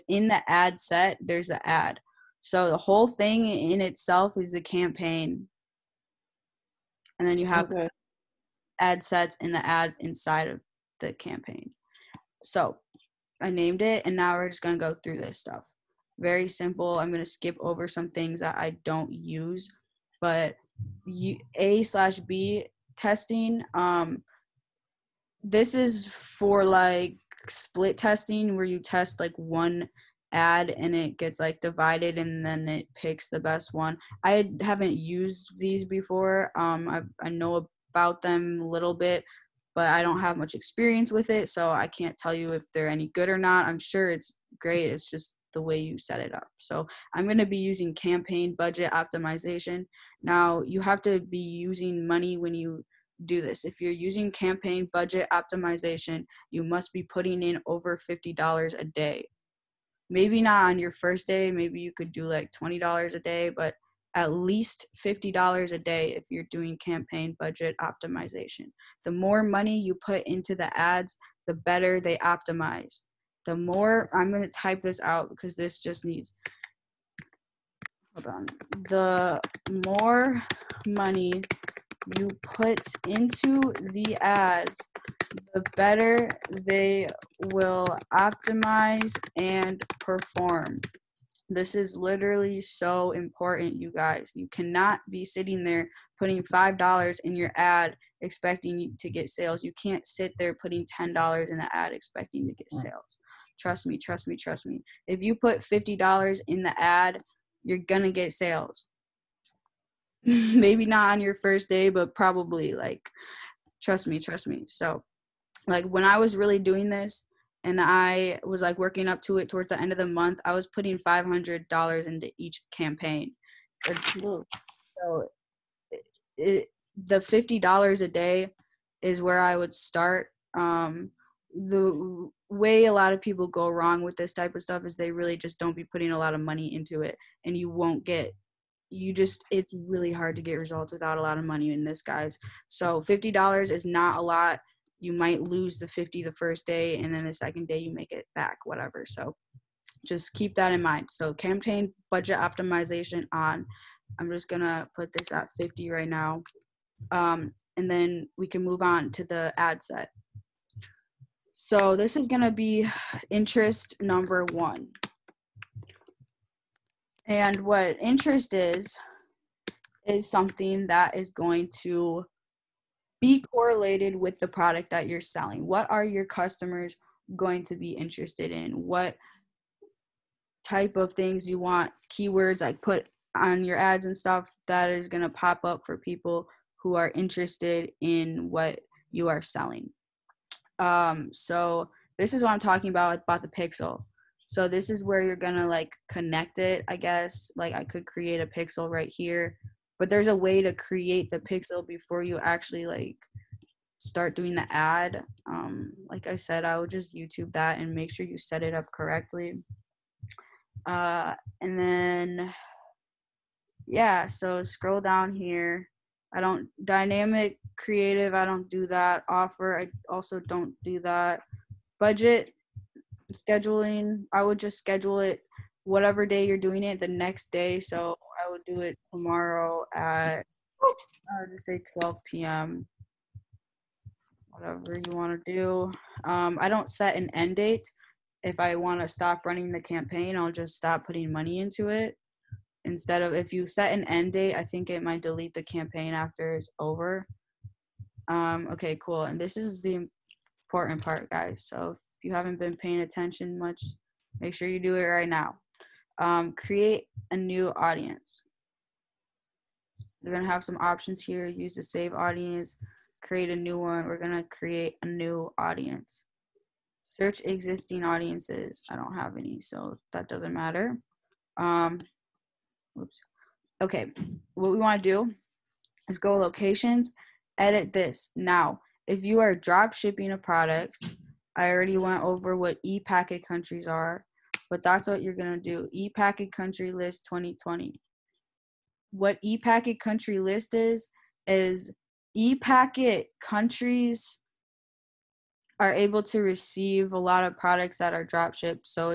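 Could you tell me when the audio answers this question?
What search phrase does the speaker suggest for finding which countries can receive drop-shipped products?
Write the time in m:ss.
4:45.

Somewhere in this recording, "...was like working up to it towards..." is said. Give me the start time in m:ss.
1:58.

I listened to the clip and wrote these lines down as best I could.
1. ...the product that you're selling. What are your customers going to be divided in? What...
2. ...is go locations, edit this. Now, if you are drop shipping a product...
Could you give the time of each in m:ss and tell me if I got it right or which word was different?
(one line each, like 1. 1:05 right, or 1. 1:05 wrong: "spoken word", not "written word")
1. 2:54 wrong: "interested", not "divided"
2. 4:36 right.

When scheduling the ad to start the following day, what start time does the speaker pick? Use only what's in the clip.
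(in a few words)
12 p.m.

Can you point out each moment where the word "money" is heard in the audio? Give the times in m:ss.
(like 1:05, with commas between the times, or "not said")
0:52, 1:09, 1:20, 2:16, 2:21, 4:01.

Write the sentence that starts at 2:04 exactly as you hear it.
So it, it, the fifty dollars a day is where I would start.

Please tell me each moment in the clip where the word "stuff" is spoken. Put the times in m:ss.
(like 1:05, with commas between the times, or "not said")
0:15, 2:14, 3:04.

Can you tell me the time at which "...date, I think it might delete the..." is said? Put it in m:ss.
4:04.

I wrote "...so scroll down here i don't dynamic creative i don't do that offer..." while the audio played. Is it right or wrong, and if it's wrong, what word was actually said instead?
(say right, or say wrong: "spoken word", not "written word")
right.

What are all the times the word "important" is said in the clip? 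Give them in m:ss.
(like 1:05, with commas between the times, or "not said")
1:33, 4:10.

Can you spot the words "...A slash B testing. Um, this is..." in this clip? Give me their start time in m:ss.
0:21.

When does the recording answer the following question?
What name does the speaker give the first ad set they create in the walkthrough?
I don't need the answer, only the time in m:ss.
2:43.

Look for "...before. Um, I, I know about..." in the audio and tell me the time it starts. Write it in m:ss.
0:35.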